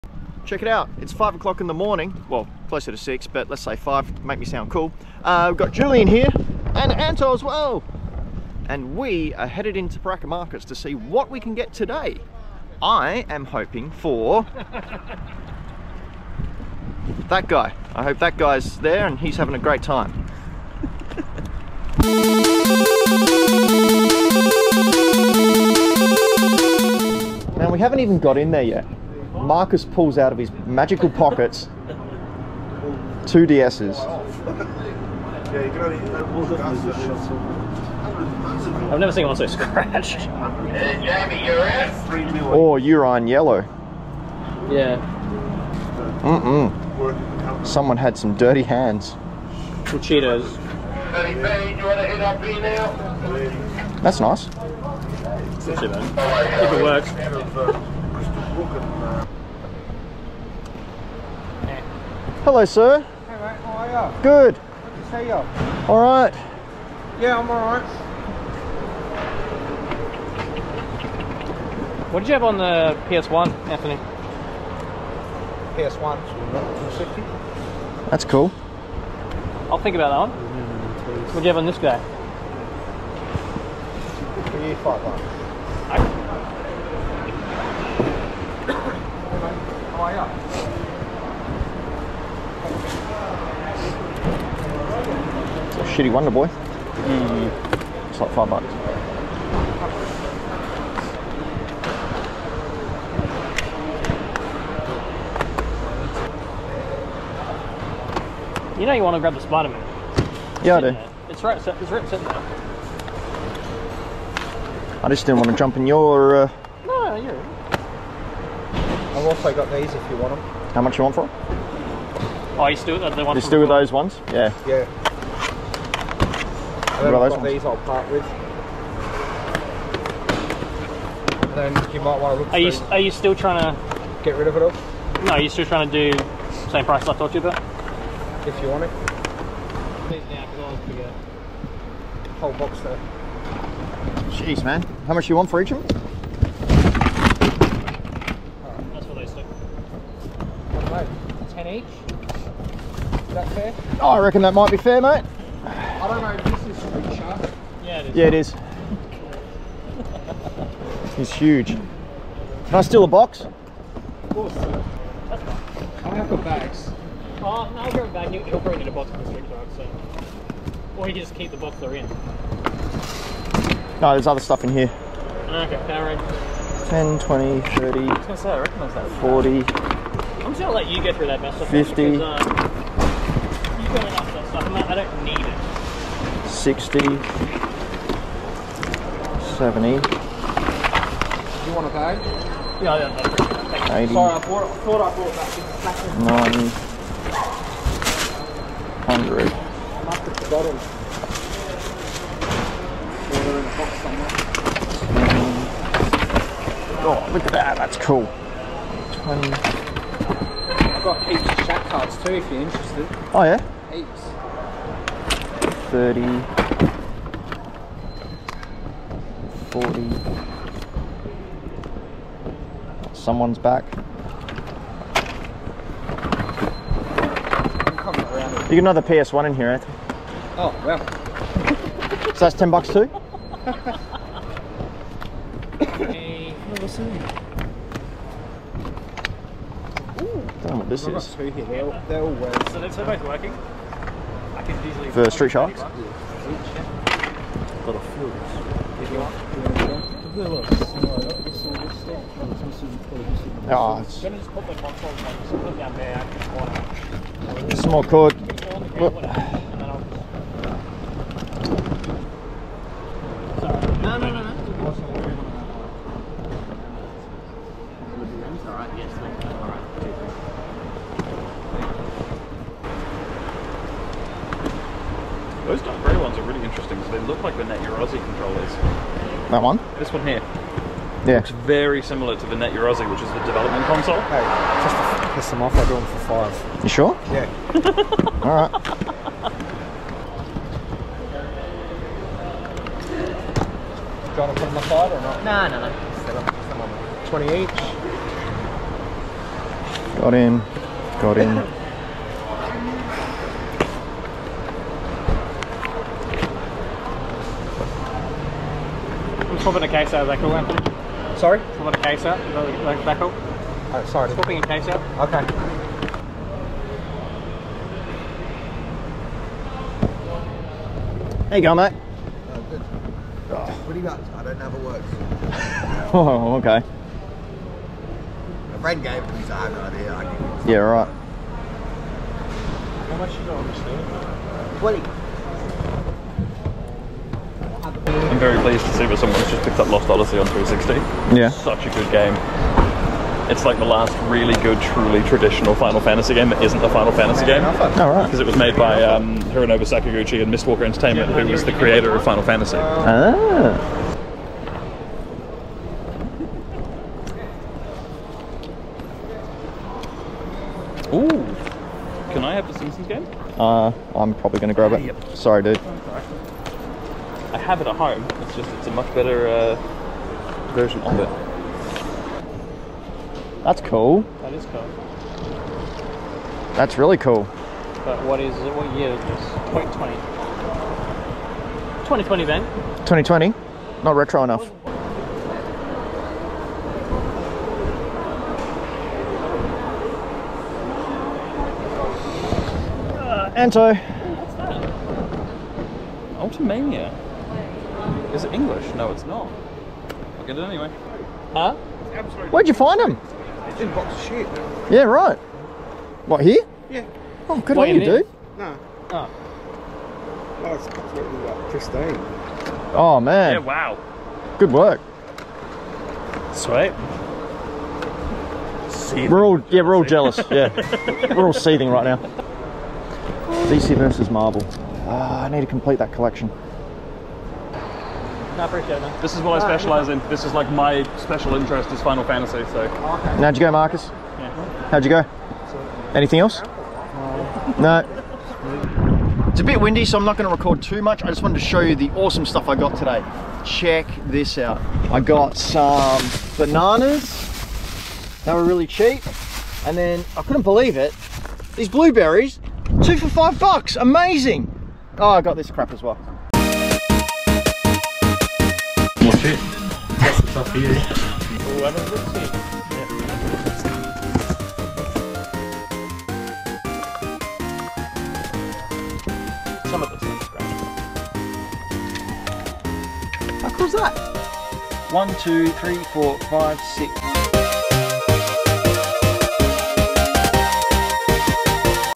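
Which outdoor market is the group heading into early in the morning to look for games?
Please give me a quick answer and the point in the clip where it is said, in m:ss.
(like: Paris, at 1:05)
Parklea Markets, at 0:09.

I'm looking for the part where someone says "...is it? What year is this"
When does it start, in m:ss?
6:18.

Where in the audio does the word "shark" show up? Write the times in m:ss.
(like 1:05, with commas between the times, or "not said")
2:37, 4:05.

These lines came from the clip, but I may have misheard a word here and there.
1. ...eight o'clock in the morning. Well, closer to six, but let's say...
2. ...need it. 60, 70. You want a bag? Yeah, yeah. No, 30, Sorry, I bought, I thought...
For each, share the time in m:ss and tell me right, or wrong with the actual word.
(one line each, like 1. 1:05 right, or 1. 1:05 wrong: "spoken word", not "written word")
1. 0:01 wrong: "five", not "eight"
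2. 3:05 wrong: "80", not "30".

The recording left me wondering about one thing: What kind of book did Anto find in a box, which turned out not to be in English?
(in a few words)
Ultimania.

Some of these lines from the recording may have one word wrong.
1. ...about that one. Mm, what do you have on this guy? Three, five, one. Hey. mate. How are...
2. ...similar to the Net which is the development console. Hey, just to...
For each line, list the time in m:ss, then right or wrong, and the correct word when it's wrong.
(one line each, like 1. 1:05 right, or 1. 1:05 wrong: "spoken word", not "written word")
1. 1:19 right
2. 4:42 right.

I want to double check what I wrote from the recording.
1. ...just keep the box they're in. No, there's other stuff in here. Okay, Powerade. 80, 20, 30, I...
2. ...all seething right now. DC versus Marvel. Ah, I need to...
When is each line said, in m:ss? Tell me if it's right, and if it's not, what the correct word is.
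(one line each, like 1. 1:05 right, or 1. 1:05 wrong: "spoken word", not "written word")
1. 2:51 wrong: "10", not "80"
2. 7:01 right.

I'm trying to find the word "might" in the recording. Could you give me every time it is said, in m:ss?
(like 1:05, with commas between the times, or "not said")
2:12, 2:34.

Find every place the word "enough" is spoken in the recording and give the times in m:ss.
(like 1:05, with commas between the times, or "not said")
3:04, 6:24.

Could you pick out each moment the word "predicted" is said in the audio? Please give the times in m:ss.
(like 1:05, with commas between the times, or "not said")
not said.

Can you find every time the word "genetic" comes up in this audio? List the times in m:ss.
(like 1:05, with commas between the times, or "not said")
not said.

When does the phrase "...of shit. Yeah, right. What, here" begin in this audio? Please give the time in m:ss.
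6:44.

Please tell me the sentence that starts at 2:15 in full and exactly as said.
No, you're still trying to do same price I told you about.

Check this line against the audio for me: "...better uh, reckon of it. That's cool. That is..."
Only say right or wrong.
wrong.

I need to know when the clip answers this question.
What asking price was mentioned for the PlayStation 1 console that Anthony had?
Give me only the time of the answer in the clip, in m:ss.
1:16.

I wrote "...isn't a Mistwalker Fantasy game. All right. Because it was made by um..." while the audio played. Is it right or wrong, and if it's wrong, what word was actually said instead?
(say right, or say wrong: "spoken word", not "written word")
wrong: "Final", not "Mistwalker".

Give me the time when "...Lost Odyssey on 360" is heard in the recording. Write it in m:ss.
5:39.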